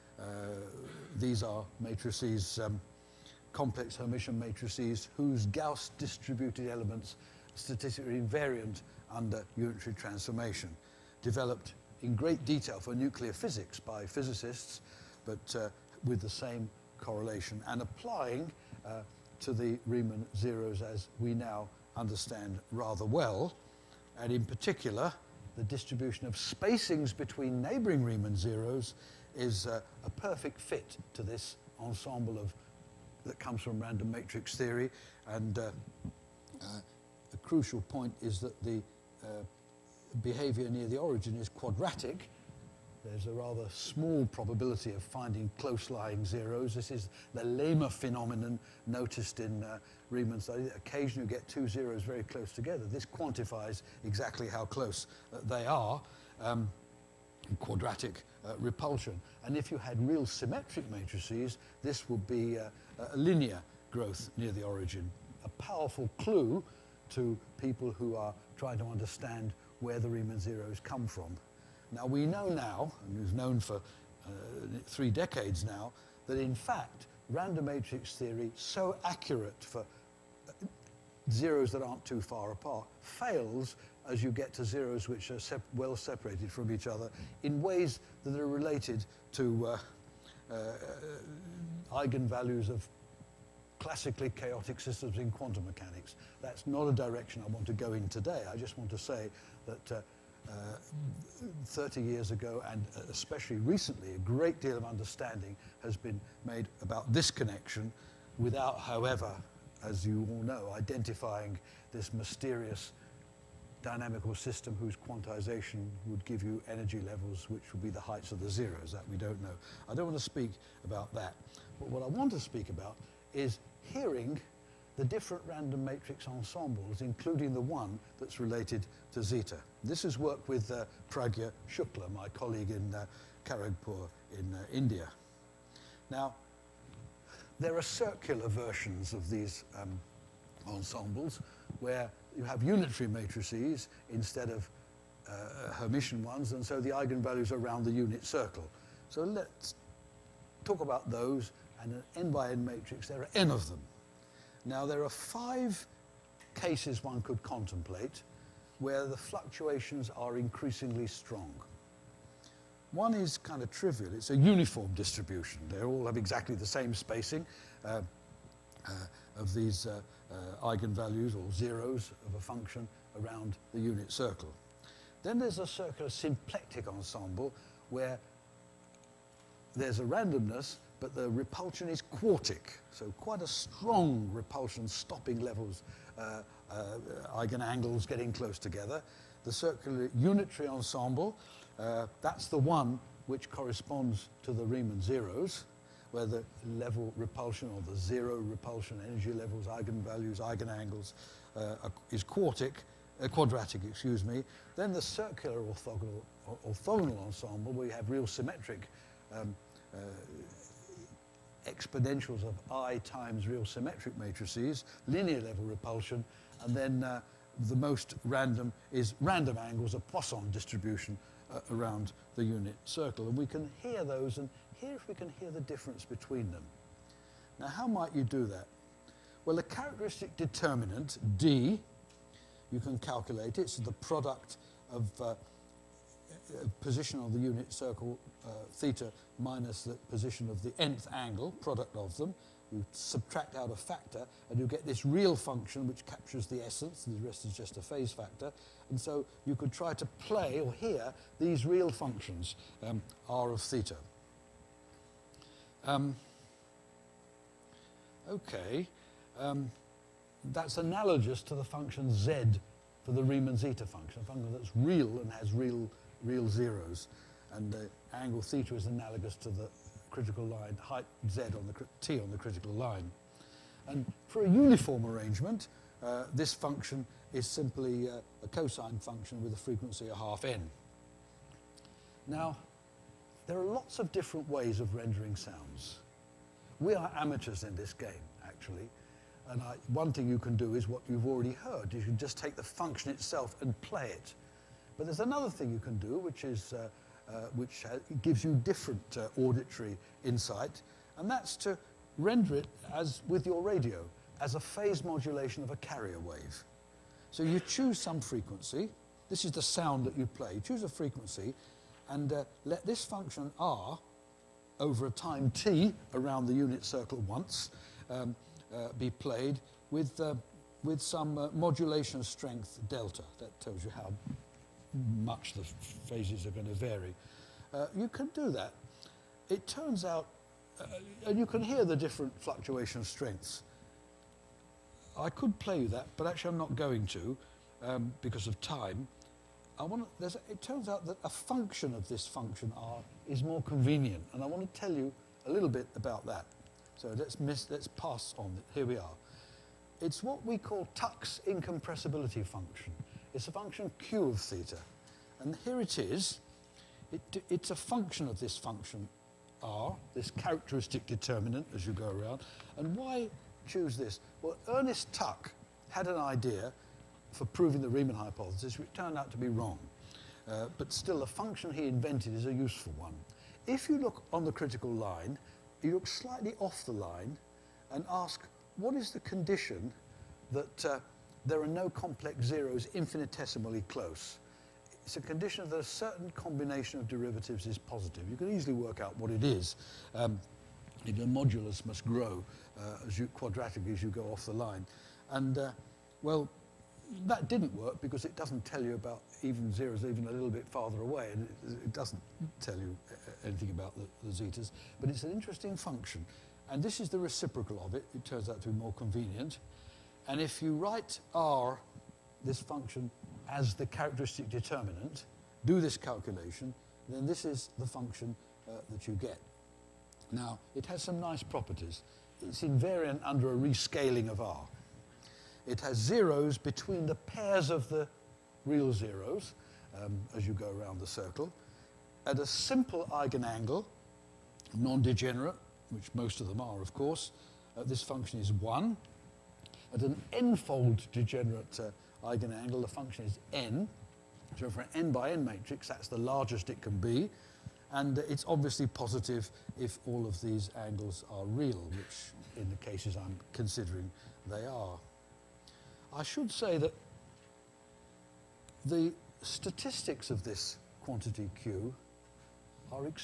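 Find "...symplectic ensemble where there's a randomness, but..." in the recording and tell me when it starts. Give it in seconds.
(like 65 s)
176 s.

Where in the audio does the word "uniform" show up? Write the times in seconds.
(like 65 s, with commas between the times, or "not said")
164 s, 274 s.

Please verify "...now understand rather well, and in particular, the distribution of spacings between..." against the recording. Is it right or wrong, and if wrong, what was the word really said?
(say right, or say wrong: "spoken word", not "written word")
right.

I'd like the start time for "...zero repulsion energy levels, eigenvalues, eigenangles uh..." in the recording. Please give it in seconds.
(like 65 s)
197 s.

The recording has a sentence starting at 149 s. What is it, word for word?
So let's talk about those and an n by n matrix.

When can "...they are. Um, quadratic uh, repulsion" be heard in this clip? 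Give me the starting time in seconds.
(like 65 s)
55 s.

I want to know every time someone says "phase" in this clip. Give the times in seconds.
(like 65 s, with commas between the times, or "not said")
247 s, 304 s, 326 s.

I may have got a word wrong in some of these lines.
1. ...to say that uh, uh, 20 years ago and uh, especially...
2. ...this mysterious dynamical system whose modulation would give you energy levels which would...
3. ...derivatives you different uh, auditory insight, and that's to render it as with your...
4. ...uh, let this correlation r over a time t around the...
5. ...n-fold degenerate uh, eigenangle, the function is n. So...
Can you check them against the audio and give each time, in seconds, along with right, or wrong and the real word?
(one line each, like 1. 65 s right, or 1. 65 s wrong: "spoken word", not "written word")
1. 98 s wrong: "30", not "20"
2. 111 s wrong: "quantization", not "modulation"
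3. 298 s wrong: "gives", not "derivatives"
4. 312 s wrong: "function", not "correlation"
5. 440 s right.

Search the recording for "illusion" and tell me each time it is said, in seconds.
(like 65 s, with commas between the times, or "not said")
not said.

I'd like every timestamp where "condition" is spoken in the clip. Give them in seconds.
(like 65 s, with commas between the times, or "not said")
379 s, 385 s.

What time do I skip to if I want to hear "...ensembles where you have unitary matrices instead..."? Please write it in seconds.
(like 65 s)
140 s.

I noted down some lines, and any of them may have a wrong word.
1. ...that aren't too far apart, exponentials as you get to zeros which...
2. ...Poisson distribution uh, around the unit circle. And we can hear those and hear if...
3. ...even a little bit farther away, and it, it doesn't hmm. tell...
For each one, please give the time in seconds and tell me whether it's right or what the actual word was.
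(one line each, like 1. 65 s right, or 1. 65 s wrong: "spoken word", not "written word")
1. 81 s wrong: "fails", not "exponentials"
2. 219 s right
3. 400 s right.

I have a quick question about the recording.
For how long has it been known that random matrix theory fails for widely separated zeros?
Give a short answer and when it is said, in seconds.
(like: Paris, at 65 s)
Three decades, at 74 s.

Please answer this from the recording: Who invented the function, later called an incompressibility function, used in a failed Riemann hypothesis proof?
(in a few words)
Ernest Tuck.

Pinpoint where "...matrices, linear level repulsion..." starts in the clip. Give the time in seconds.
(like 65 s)
214 s.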